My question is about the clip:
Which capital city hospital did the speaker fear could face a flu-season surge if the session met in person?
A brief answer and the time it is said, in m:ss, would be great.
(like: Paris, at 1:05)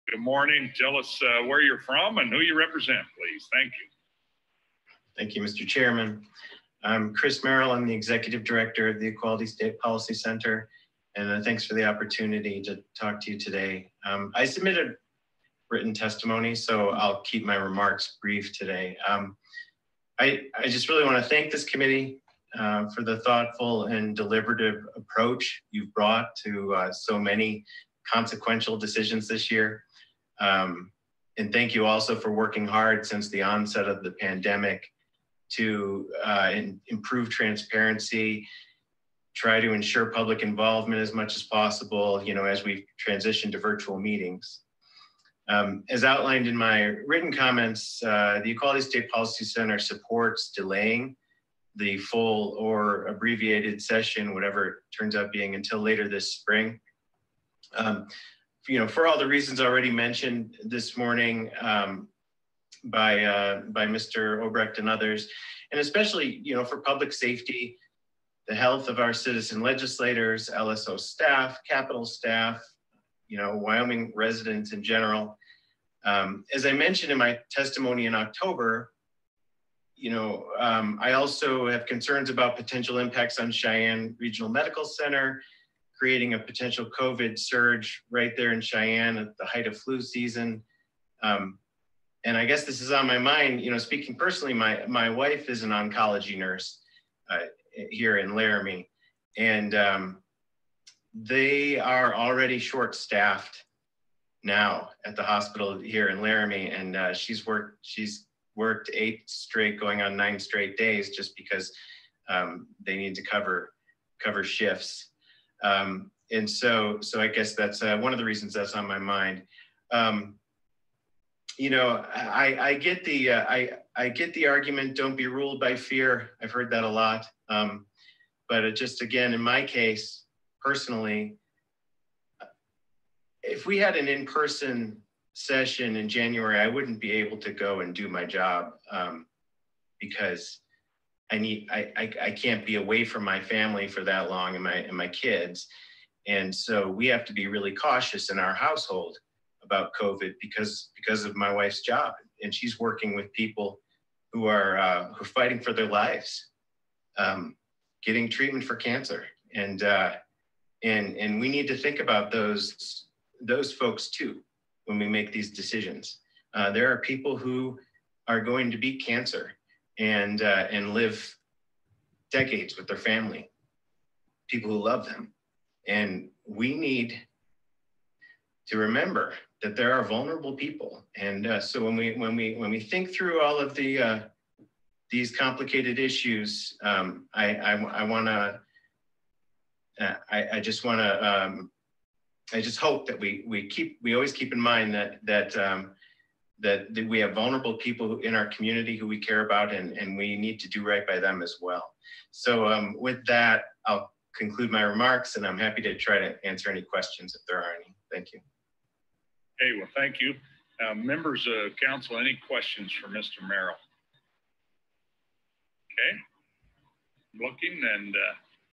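Cheyenne Regional Medical Center, at 1:23.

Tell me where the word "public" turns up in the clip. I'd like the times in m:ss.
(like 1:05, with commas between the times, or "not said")
0:40, 1:06.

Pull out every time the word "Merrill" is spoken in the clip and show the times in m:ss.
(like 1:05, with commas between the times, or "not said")
0:07, 3:33.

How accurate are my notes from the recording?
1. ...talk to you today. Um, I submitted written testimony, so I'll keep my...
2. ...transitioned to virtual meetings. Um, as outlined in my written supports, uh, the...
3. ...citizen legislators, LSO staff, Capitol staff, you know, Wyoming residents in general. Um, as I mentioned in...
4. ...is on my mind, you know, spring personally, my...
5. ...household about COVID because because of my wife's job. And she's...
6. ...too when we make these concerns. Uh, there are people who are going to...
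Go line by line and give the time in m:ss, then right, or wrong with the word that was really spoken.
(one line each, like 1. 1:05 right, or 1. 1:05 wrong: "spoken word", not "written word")
1. 0:12 right
2. 0:43 wrong: "comments", not "supports"
3. 1:09 right
4. 1:32 wrong: "speaking", not "spring"
5. 2:28 right
6. 2:44 wrong: "decisions", not "concerns".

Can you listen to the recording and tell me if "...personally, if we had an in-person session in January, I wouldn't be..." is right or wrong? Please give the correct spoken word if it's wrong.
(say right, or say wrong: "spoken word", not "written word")
right.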